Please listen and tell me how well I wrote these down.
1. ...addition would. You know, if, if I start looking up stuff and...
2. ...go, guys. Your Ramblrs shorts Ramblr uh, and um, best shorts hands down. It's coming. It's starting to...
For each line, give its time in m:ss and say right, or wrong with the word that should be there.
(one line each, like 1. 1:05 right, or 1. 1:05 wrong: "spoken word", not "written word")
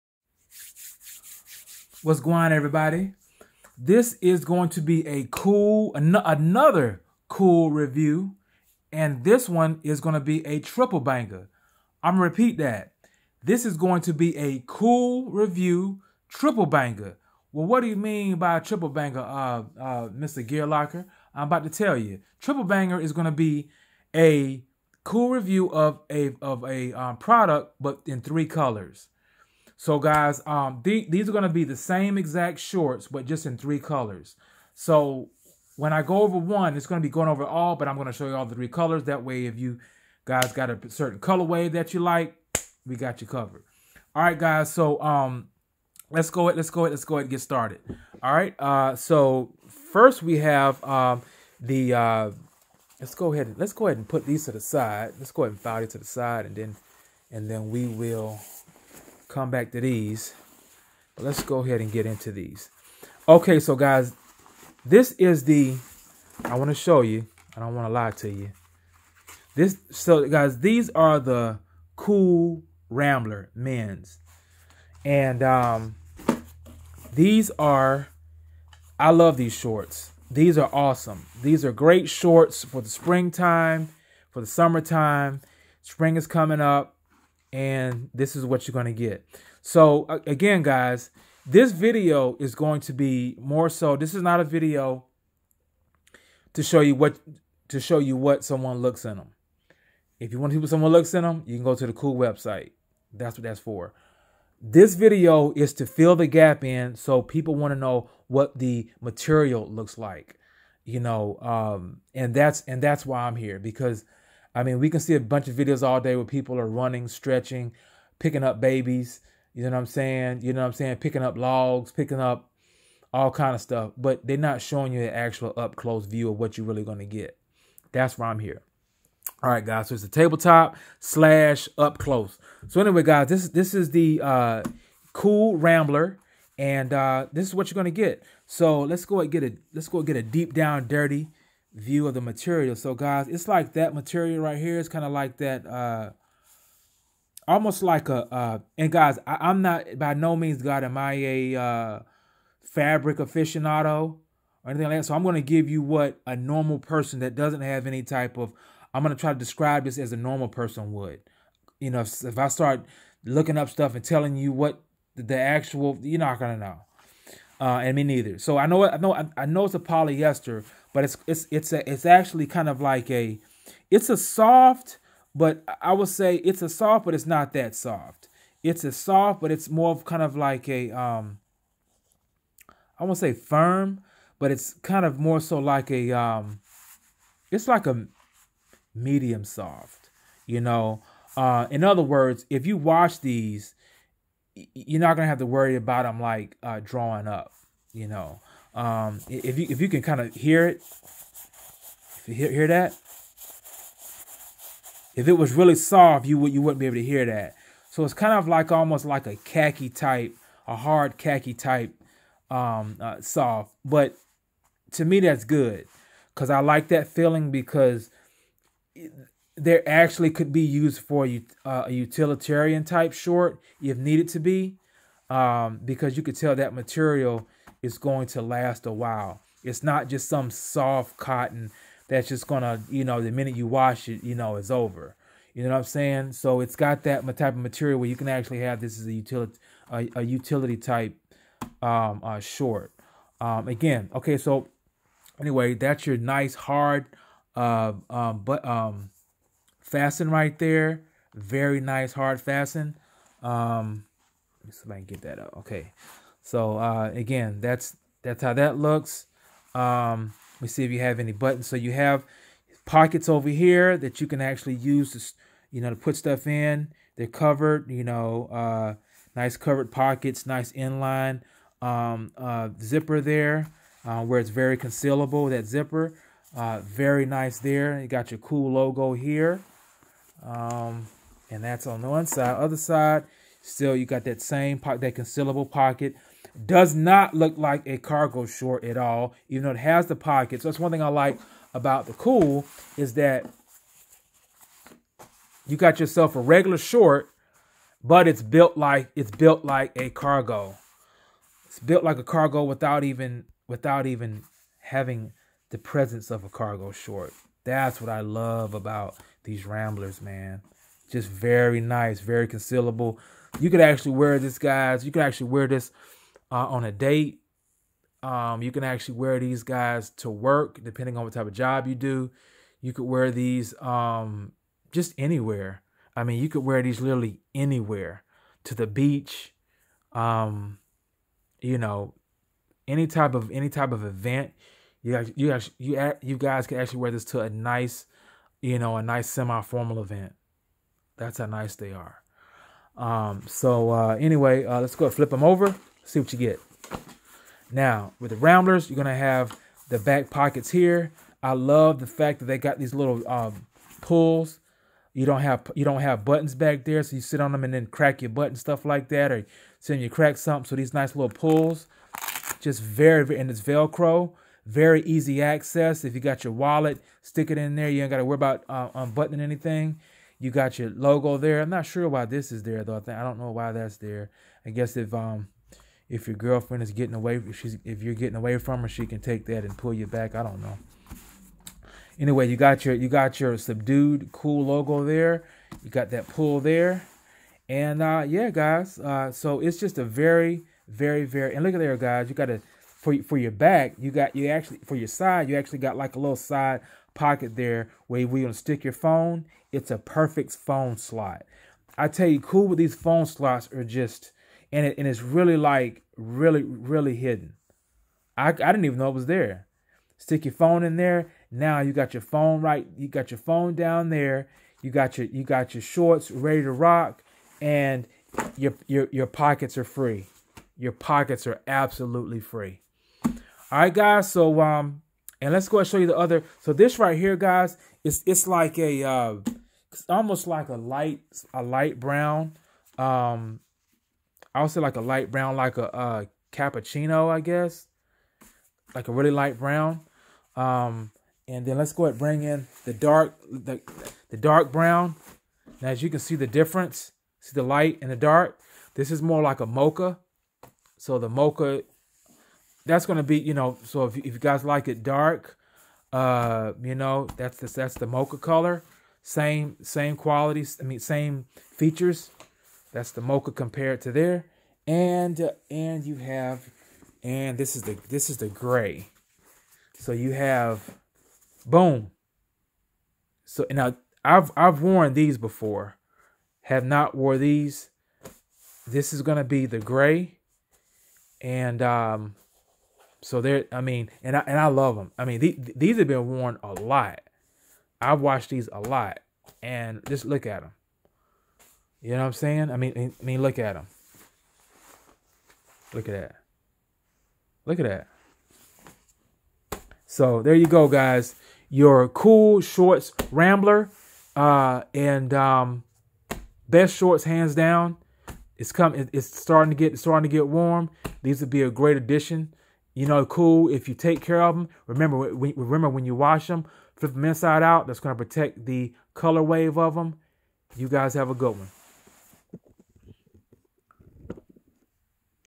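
1. 2:40 wrong: "person", not "addition"
2. 8:20 wrong: "Kuhl", not "Ramblrs".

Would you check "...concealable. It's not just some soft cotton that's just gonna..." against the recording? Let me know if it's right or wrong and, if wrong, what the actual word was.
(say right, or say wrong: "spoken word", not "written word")
wrong: "while", not "concealable".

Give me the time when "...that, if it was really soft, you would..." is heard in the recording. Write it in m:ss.
3:22.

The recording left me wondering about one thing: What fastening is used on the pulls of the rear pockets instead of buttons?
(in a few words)
Velcro.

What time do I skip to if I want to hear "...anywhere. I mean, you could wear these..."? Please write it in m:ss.
5:25.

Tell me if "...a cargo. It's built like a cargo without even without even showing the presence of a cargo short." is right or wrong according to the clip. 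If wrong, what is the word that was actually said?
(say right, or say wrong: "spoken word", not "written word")
wrong: "having", not "showing".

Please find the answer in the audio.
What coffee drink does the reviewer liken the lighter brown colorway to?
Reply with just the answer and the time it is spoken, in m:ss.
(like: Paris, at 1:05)
Cappuccino, at 7:16.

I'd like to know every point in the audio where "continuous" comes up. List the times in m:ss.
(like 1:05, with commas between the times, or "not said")
not said.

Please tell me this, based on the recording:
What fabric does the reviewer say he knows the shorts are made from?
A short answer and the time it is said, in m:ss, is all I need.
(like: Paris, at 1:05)
Polyester, at 2:49.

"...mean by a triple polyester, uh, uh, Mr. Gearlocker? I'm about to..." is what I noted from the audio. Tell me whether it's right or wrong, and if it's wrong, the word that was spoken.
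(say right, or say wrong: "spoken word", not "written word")
wrong: "banger", not "polyester".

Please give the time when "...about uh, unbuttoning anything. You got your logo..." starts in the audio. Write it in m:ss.
6:08.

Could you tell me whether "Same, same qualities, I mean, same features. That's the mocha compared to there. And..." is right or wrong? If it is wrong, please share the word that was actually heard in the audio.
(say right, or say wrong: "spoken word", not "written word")
right.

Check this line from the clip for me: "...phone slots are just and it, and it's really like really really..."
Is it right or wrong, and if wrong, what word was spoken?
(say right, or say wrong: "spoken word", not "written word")
right.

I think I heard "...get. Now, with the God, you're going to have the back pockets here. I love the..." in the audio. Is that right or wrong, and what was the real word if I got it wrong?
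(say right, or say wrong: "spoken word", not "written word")
wrong: "Ramblrs", not "God".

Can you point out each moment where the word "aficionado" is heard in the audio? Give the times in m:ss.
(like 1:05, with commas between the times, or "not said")
2:33.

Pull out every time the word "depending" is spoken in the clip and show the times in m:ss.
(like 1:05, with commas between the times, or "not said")
5:20.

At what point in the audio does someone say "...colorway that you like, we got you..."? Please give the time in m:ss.
0:41.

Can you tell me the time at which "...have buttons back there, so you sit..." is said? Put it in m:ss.
5:56.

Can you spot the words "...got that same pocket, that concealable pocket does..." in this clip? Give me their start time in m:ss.
4:44.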